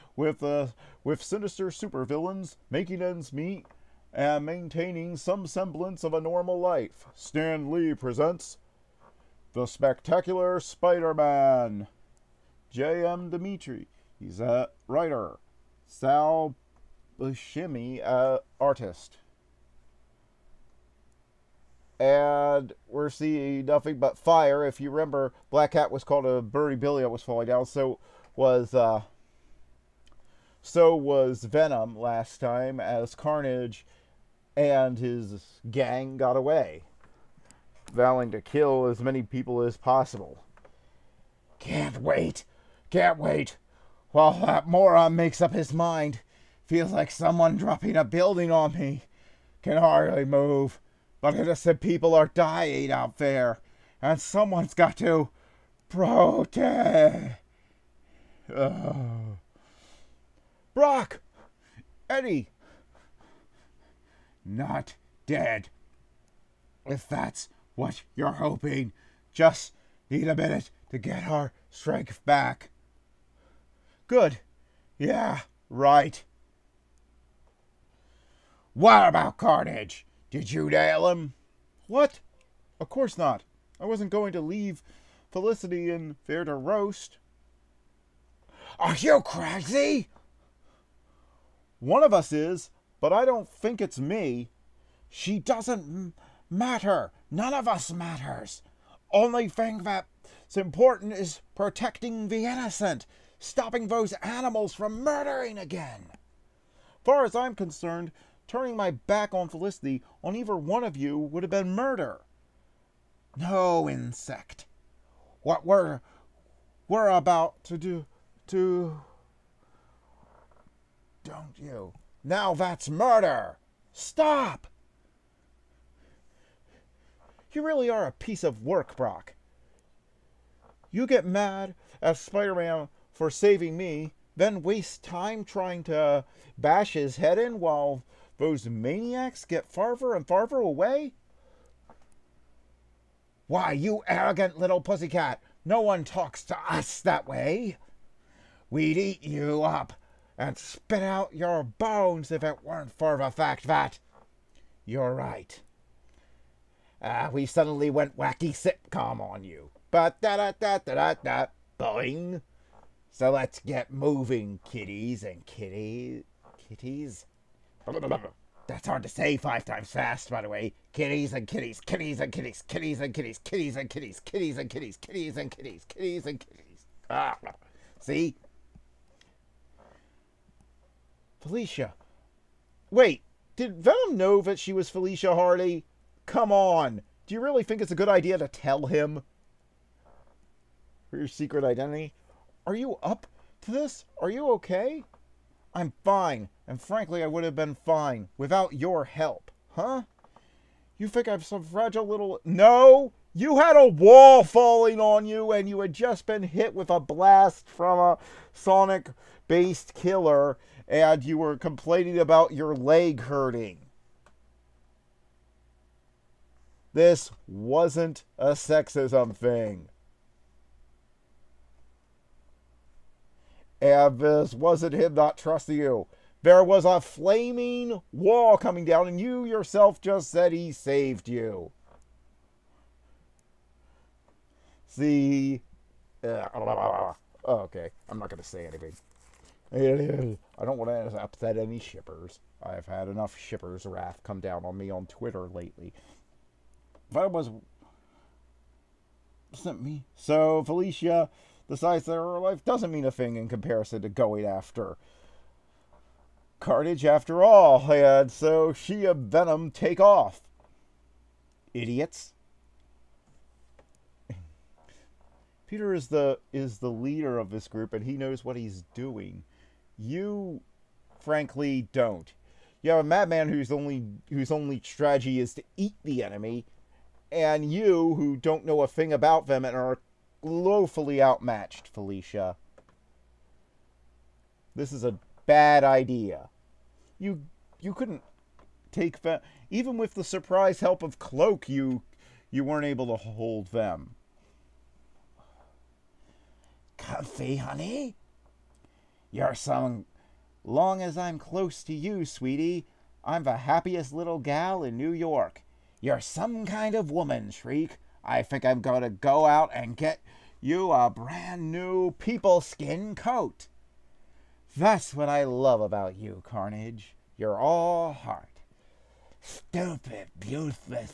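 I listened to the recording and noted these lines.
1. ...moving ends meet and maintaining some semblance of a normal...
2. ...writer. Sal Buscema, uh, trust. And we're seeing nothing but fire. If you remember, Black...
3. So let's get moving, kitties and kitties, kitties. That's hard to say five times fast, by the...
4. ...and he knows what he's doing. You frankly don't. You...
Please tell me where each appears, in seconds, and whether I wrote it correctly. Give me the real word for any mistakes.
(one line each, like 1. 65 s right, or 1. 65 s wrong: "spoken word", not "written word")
1. 2 s wrong: "making", not "moving"
2. 14 s wrong: "artist", not "trust"
3. 163 s right
4. 267 s right.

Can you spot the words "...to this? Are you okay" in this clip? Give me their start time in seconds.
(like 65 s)
193 s.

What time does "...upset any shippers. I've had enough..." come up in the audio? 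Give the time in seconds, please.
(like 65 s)
241 s.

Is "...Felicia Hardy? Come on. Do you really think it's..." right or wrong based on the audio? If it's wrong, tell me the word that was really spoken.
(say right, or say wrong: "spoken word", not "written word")
right.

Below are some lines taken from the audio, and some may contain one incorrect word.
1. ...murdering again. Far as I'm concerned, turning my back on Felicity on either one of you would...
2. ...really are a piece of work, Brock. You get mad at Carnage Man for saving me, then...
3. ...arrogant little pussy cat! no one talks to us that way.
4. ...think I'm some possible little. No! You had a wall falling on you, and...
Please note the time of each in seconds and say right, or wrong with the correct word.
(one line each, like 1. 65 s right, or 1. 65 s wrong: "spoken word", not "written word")
1. 105 s right
2. 127 s wrong: "Spider", not "Carnage"
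3. 144 s right
4. 201 s wrong: "fragile", not "possible".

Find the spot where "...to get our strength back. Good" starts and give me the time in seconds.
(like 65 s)
70 s.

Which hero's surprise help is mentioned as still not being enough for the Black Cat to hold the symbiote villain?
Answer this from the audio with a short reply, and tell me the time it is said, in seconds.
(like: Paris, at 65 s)
Cloak, at 291 s.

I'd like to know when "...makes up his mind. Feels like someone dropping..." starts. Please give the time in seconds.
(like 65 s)
45 s.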